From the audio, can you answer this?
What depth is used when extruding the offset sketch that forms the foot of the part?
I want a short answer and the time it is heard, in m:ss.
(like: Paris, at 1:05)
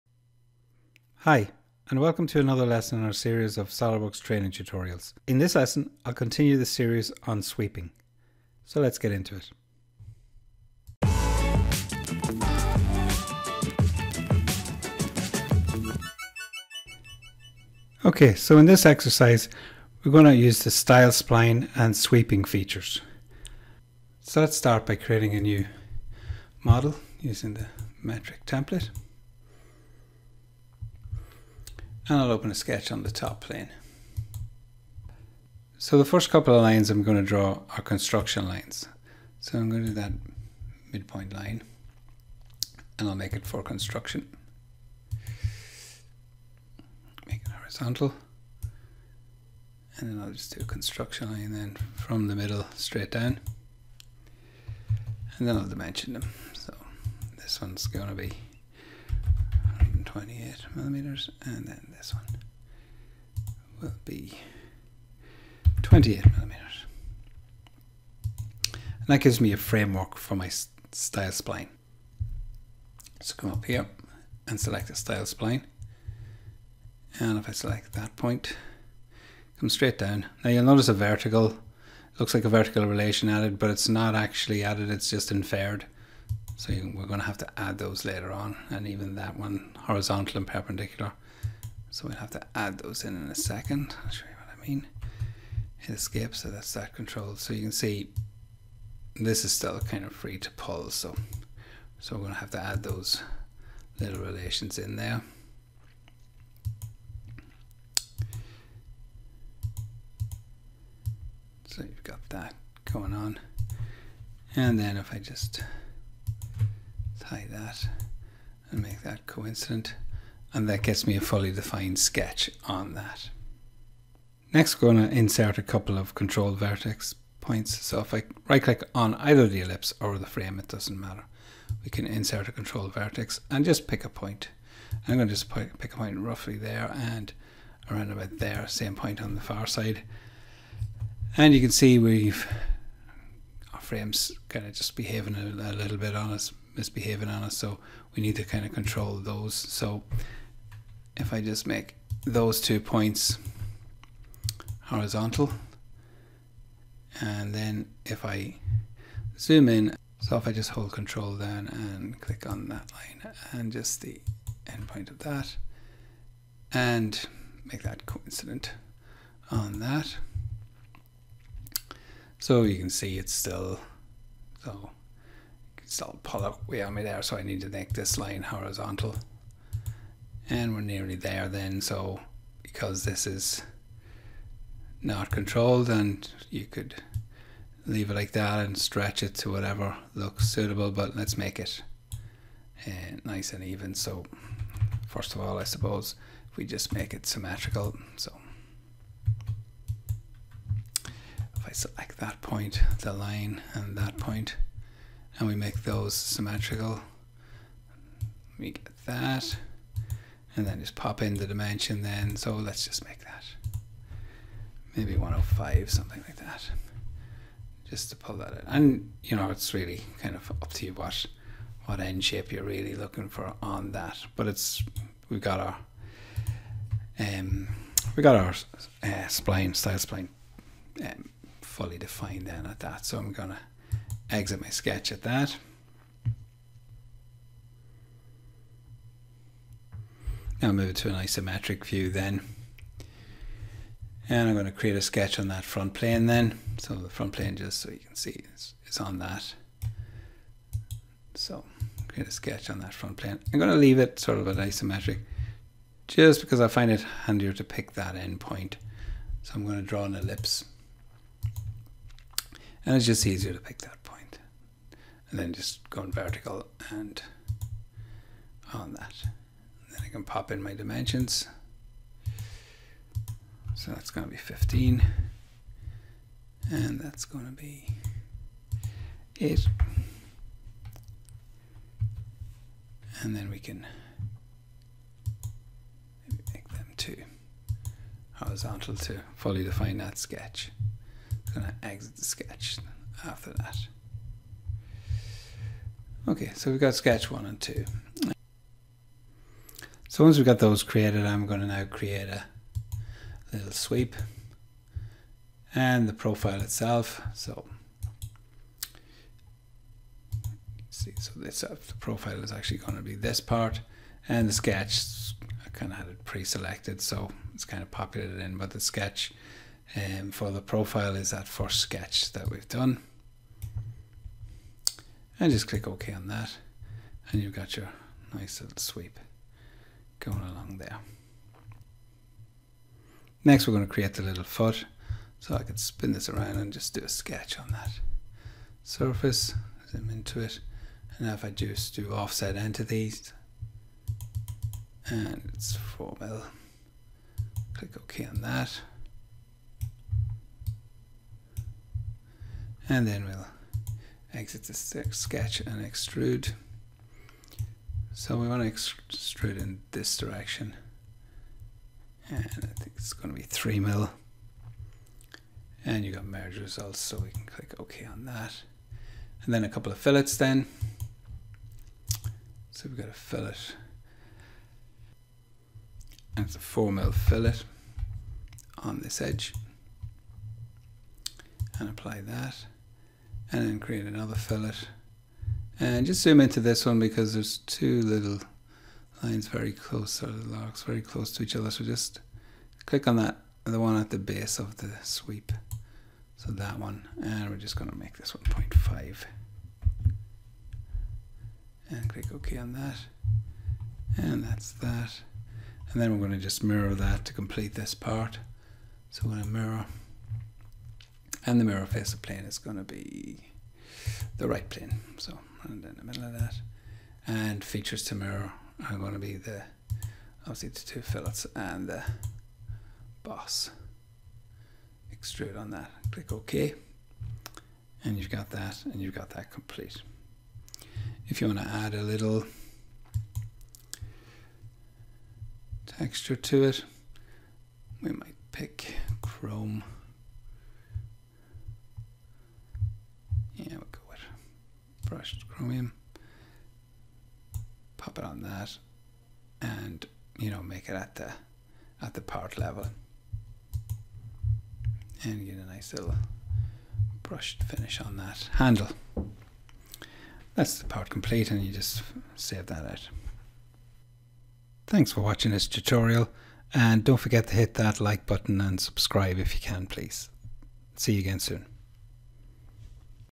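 3 mil, at 6:03.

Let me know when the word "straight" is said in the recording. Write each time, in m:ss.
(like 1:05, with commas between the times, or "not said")
0:52, 1:19.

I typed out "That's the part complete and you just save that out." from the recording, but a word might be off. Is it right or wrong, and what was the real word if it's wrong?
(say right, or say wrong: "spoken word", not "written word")
right.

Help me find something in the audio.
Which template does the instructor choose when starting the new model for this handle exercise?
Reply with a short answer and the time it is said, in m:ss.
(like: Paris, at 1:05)
metric, at 0:28.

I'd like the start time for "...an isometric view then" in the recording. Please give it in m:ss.
4:01.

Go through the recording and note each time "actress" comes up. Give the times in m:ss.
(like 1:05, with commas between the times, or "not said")
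not said.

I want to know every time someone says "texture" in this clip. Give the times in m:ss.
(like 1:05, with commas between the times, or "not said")
7:15.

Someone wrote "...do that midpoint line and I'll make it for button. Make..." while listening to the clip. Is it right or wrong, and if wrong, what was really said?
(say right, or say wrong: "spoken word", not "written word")
wrong: "construction", not "button".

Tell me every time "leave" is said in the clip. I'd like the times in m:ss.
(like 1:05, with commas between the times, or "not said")
3:07, 4:13.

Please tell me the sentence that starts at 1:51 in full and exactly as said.
So you've got that going on.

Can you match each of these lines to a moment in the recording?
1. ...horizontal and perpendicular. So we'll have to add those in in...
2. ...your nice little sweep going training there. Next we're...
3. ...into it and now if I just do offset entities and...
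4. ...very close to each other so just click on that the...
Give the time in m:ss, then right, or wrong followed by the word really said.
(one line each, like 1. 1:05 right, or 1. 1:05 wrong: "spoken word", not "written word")
1. 1:29 right
2. 5:27 wrong: "along", not "training"
3. 5:40 right
4. 6:30 right.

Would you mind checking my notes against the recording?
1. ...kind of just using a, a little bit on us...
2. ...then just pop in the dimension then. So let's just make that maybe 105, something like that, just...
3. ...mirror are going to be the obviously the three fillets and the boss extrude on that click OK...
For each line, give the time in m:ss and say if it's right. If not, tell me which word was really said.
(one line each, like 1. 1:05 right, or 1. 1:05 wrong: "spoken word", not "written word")
1. 2:24 wrong: "behaving", not "using"
2. 3:30 right
3. 6:58 wrong: "two", not "three".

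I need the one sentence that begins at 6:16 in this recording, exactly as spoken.
And it's a 4 mil fillet on this edge.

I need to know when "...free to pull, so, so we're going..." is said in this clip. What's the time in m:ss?
1:40.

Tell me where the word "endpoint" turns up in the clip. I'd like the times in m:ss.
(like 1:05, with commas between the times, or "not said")
2:44, 4:18.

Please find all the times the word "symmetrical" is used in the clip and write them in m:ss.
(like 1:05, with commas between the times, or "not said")
3:17, 3:26.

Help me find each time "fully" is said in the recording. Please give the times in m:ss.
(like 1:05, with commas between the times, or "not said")
2:01, 3:51, 4:49.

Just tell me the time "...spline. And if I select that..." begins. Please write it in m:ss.
1:15.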